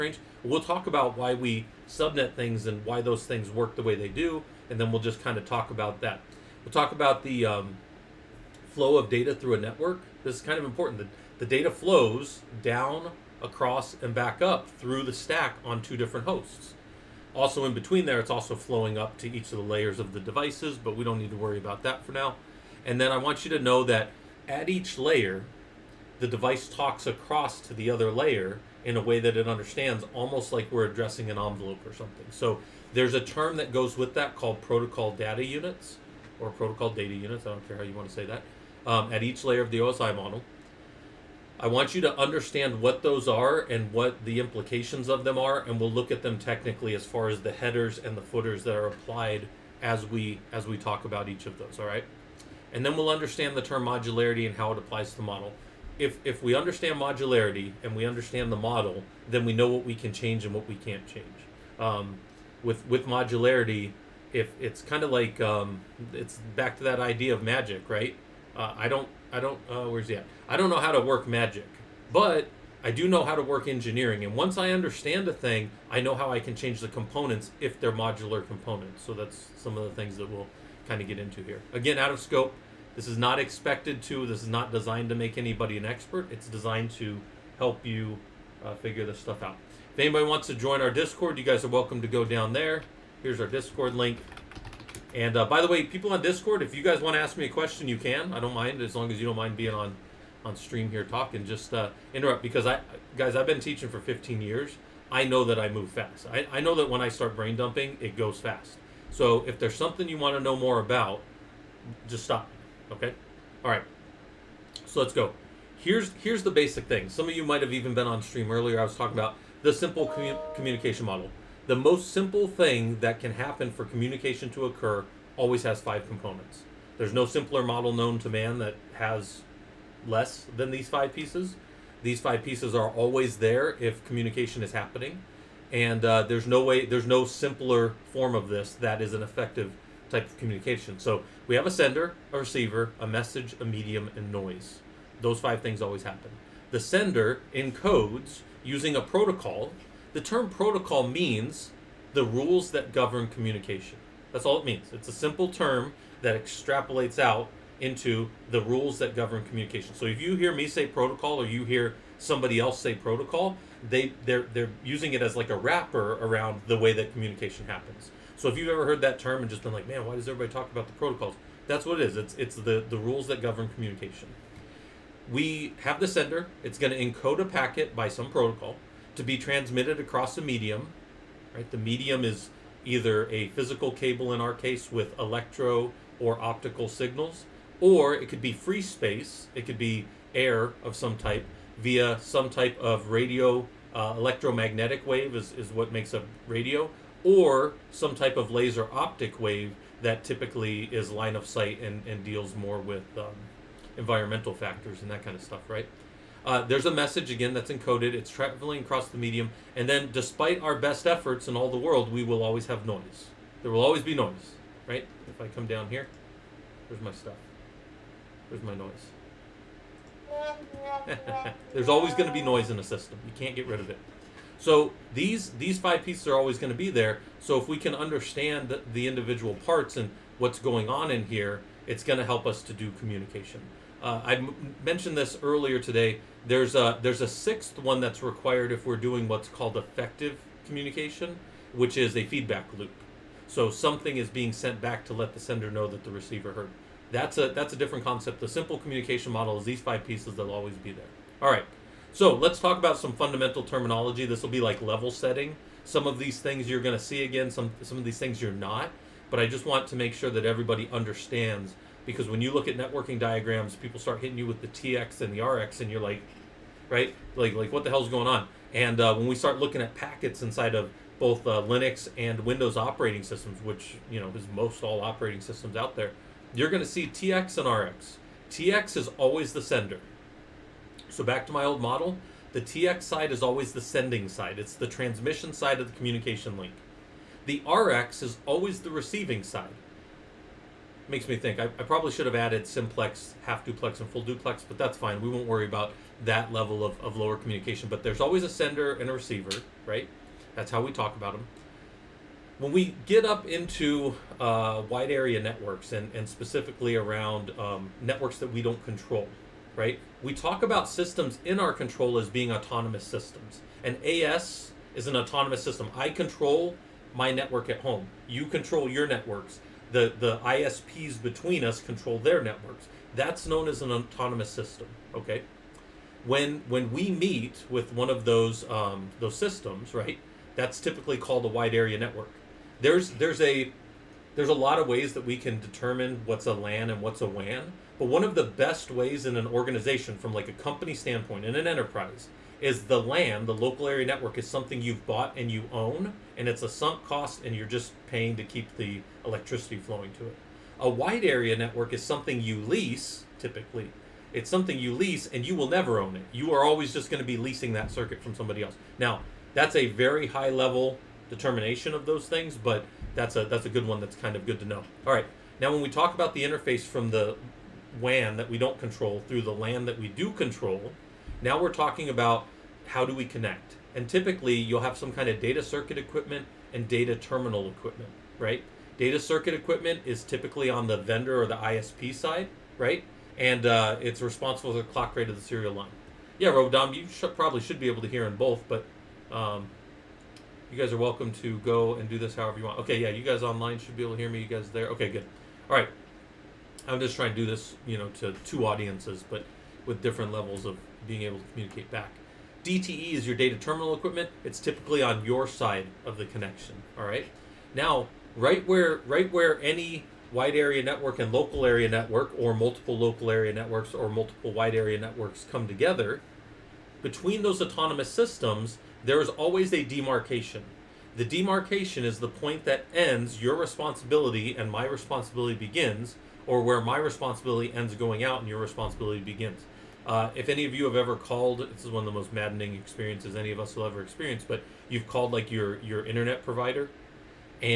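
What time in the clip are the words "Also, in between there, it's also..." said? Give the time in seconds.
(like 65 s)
17 s.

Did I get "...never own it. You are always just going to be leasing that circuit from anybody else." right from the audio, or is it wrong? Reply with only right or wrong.
wrong.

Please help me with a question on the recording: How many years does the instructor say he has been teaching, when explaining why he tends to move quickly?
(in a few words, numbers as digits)
15.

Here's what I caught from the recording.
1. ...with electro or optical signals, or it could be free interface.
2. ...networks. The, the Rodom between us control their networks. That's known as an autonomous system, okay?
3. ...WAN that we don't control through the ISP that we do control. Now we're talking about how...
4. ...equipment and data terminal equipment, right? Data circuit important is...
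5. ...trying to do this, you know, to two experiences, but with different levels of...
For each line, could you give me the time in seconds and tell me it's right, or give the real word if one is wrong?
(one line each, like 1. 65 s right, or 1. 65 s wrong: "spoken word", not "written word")
1. 184 s wrong: "space", not "interface"
2. 319 s wrong: "ISPs", not "Rodom"
3. 368 s wrong: "LAN", not "ISP"
4. 375 s wrong: "equipment", not "important"
5. 397 s wrong: "audiences", not "experiences".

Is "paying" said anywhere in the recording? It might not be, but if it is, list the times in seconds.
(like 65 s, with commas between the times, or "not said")
348 s.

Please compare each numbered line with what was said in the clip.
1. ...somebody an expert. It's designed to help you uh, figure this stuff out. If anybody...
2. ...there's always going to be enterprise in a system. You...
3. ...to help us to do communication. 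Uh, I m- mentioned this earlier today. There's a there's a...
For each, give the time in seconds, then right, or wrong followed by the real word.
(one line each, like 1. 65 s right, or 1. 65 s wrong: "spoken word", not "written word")
1. 85 s wrong: "anybody", not "somebody"
2. 221 s wrong: "noise", not "enterprise"
3. 232 s right.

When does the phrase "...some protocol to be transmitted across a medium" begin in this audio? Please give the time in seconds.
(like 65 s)
178 s.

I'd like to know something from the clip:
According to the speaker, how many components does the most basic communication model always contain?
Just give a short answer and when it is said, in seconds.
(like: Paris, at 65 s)
5, at 125 s.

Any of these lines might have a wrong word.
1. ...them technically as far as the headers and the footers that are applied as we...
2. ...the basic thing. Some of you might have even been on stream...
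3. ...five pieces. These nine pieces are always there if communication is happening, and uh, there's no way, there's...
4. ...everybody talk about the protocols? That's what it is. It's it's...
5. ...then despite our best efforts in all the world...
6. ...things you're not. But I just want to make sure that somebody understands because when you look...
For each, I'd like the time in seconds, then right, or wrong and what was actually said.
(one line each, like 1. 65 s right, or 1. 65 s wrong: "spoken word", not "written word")
1. 46 s right
2. 116 s right
3. 130 s wrong: "five", not "nine"
4. 170 s right
5. 209 s right
6. 258 s wrong: "everybody", not "somebody".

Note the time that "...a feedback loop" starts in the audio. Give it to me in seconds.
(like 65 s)
242 s.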